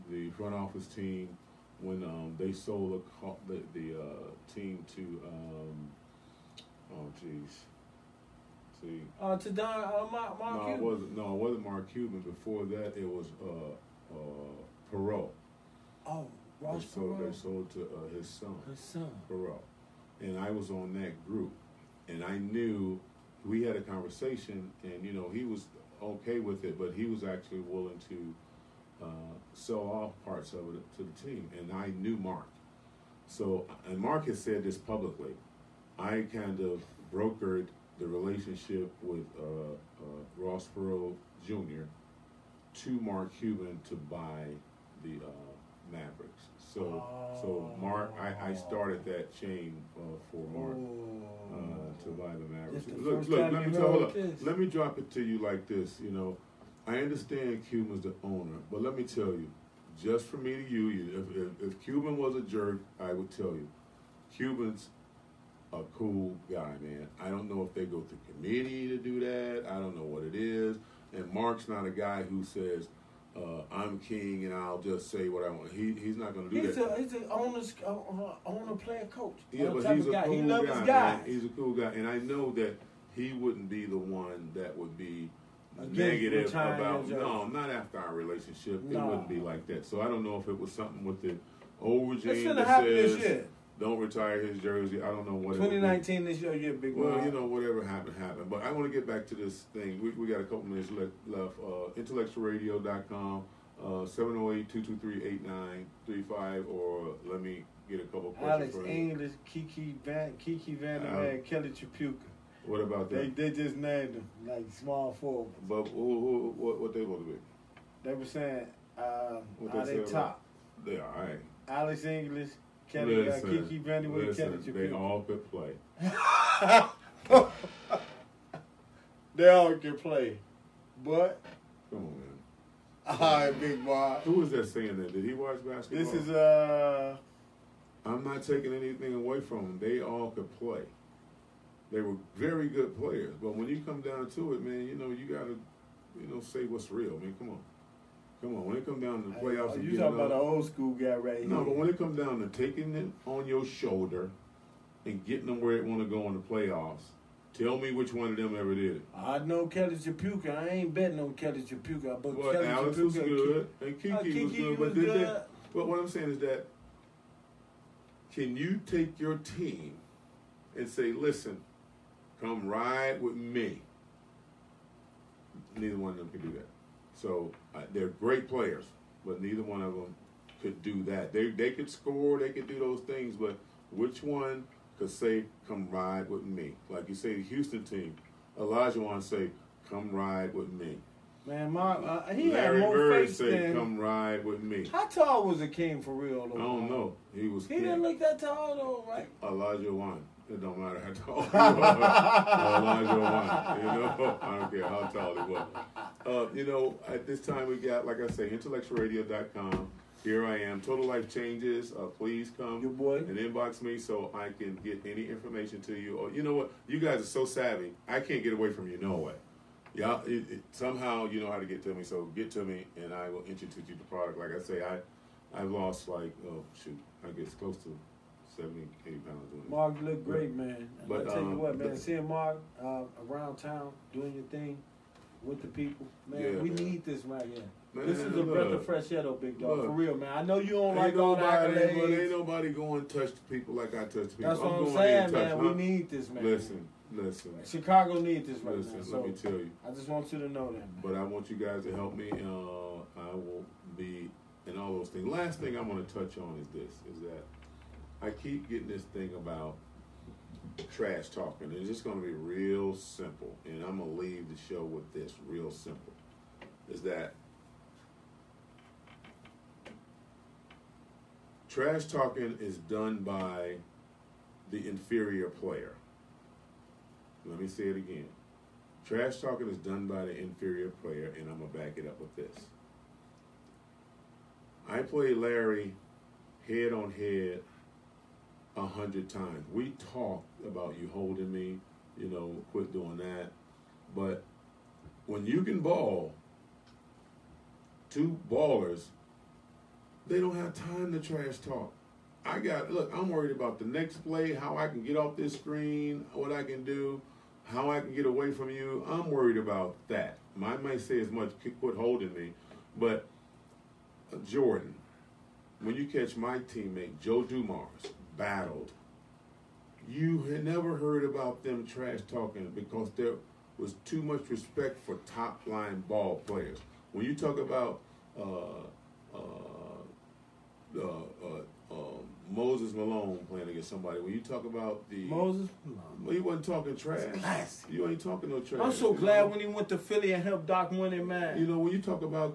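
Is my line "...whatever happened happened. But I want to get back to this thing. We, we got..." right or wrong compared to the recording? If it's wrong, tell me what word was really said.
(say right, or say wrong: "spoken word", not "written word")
right.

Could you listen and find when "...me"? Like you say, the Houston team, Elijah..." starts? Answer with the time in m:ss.
3:06.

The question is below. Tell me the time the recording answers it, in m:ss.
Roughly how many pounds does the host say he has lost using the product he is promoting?
3:48.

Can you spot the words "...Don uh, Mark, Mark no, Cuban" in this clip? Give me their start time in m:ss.
0:09.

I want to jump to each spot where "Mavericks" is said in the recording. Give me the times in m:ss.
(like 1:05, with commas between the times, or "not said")
0:45, 0:52.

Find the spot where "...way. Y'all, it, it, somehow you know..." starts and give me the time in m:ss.
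3:39.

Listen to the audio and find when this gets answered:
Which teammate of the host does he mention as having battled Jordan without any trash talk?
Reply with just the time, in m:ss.
5:17.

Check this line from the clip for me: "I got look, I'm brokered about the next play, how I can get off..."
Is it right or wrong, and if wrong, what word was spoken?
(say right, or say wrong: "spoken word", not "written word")
wrong: "worried", not "brokered".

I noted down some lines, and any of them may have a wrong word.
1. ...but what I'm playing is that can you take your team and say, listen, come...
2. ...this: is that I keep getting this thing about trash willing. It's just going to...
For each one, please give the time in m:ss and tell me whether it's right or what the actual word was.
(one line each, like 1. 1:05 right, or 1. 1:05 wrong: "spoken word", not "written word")
1. 2:45 wrong: "saying", not "playing"
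2. 4:16 wrong: "talking", not "willing".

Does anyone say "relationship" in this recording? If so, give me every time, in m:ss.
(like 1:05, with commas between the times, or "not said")
0:38, 1:28.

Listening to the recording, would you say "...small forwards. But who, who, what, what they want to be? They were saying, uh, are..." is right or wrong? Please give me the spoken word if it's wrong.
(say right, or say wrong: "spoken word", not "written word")
right.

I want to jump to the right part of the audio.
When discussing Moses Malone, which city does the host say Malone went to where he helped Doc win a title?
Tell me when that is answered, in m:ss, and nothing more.
5:39.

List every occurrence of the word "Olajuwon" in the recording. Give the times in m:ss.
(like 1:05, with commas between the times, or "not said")
3:19.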